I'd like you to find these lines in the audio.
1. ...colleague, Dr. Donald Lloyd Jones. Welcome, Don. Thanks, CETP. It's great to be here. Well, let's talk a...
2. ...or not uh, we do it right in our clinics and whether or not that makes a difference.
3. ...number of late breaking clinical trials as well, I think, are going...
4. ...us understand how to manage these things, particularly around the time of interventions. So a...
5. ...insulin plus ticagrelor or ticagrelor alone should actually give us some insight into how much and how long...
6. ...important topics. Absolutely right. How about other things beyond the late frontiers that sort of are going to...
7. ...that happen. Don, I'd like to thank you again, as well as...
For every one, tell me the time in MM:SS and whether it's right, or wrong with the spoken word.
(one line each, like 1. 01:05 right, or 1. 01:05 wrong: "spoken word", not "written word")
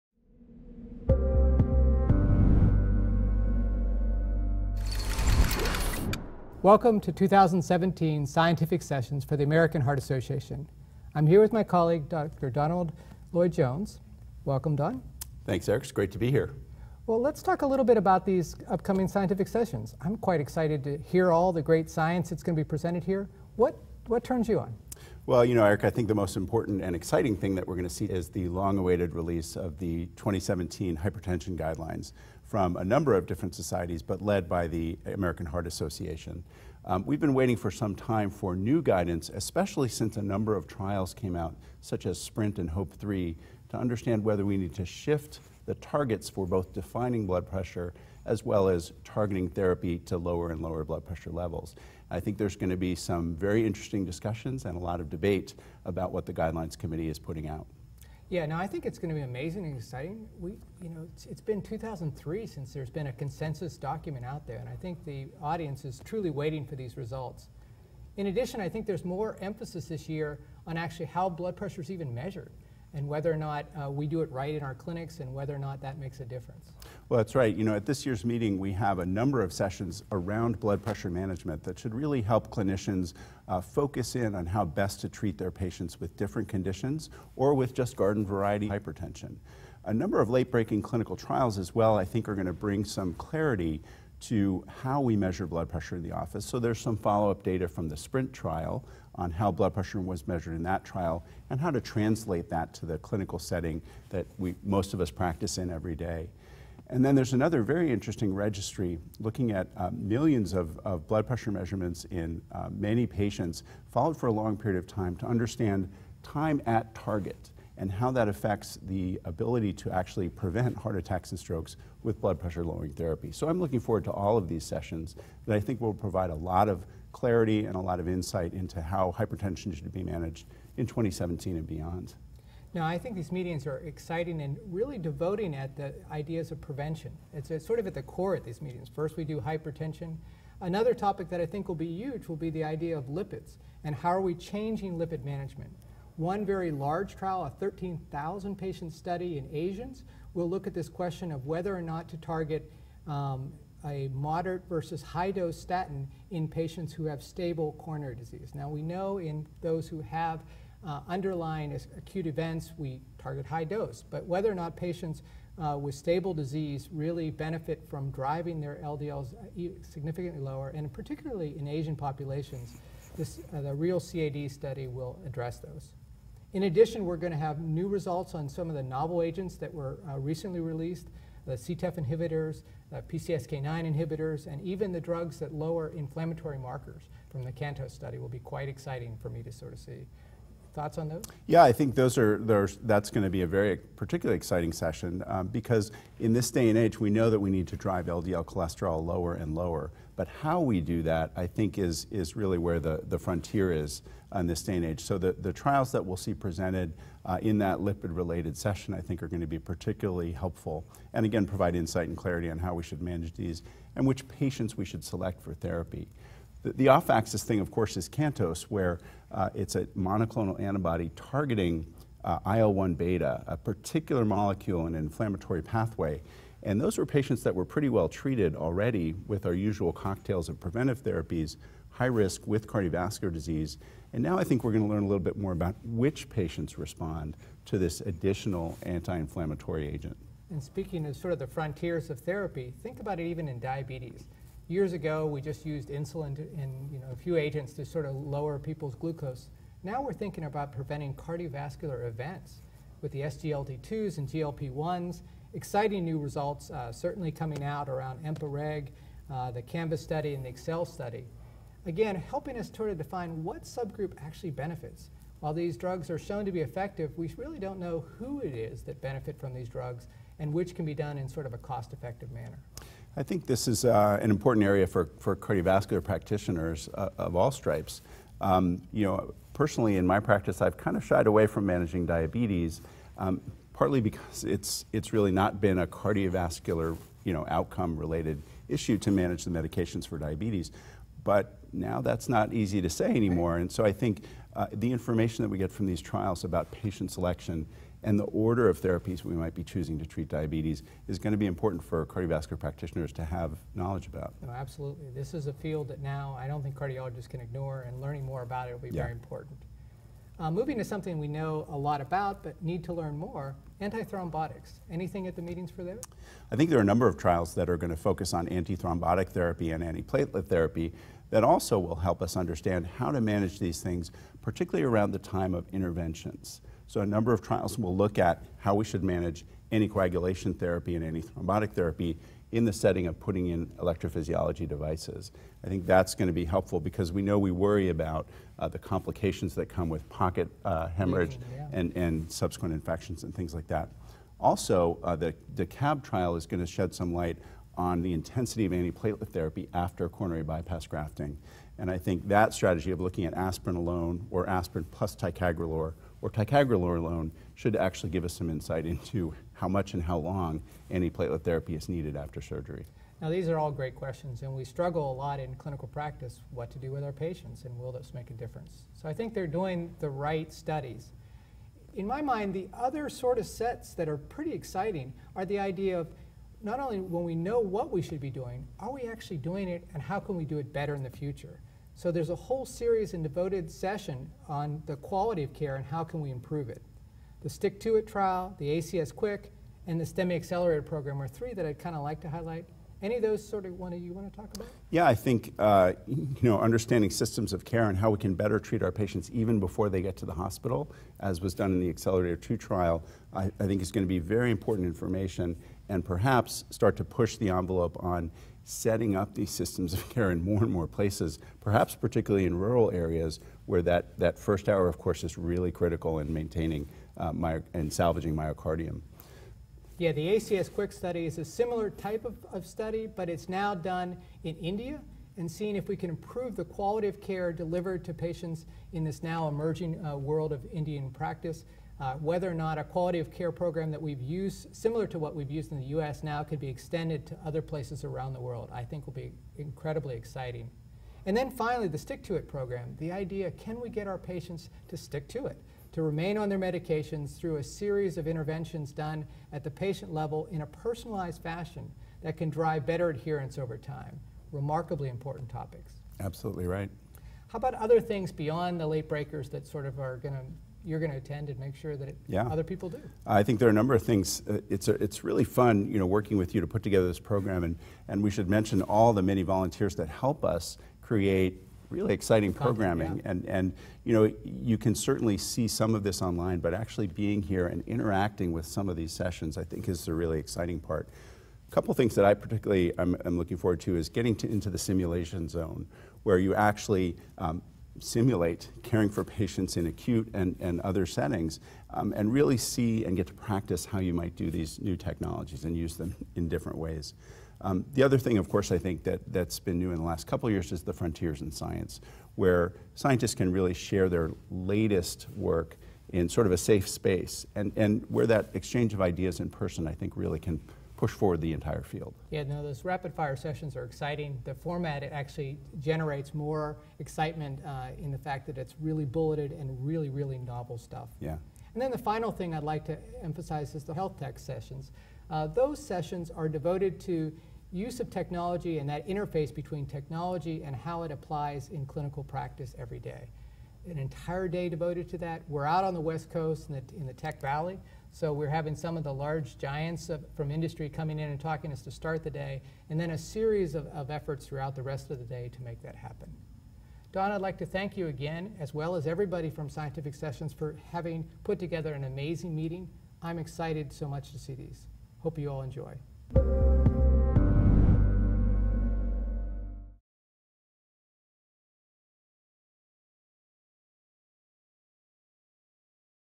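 1. 00:11 wrong: "Eric", not "CETP"
2. 01:13 right
3. 01:29 right
4. 05:22 right
5. 05:54 wrong: "aspirin", not "insulin"
6. 07:35 wrong: "breakers", not "frontiers"
7. 09:05 right.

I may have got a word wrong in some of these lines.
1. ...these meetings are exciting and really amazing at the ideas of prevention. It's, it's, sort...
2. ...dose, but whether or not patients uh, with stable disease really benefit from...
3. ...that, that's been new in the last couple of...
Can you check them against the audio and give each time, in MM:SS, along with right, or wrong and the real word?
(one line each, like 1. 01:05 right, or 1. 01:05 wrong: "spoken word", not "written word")
1. 02:13 wrong: "devoting", not "amazing"
2. 02:43 right
3. 08:19 right.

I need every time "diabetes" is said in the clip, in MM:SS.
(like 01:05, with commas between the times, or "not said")
04:03, 04:42, 04:50, 05:00.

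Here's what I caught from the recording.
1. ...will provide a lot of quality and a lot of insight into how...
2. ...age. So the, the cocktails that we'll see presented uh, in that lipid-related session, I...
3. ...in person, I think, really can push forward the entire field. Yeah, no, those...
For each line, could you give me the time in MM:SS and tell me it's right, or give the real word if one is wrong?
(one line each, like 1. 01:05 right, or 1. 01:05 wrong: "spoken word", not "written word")
1. 02:05 wrong: "clarity", not "quality"
2. 03:24 wrong: "trials", not "cocktails"
3. 08:29 right.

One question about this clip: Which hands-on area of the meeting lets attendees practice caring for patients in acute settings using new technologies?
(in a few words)
simulation zone.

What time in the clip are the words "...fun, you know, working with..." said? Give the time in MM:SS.
07:45.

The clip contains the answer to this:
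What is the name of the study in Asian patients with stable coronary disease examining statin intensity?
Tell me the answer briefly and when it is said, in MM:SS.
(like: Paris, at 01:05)
REAL-CAD, at 02:53.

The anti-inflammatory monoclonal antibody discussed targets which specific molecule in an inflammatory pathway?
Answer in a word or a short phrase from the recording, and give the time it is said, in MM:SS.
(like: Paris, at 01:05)
IL-1 beta, at 03:42.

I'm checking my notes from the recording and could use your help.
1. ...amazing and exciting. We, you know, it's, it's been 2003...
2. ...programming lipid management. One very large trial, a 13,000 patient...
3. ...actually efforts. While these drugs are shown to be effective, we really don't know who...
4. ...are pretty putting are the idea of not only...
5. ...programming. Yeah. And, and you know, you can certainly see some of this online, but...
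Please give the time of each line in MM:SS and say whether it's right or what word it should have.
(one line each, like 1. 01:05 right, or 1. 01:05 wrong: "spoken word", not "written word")
1. 00:59 right
2. 02:24 wrong: "changing", not "programming"
3. 04:24 wrong: "benefits", not "efforts"
4. 06:14 wrong: "exciting", not "putting"
5. 07:52 right.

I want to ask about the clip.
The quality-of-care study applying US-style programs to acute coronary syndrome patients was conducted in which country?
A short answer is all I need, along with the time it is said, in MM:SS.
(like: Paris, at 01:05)
India, at 07:04.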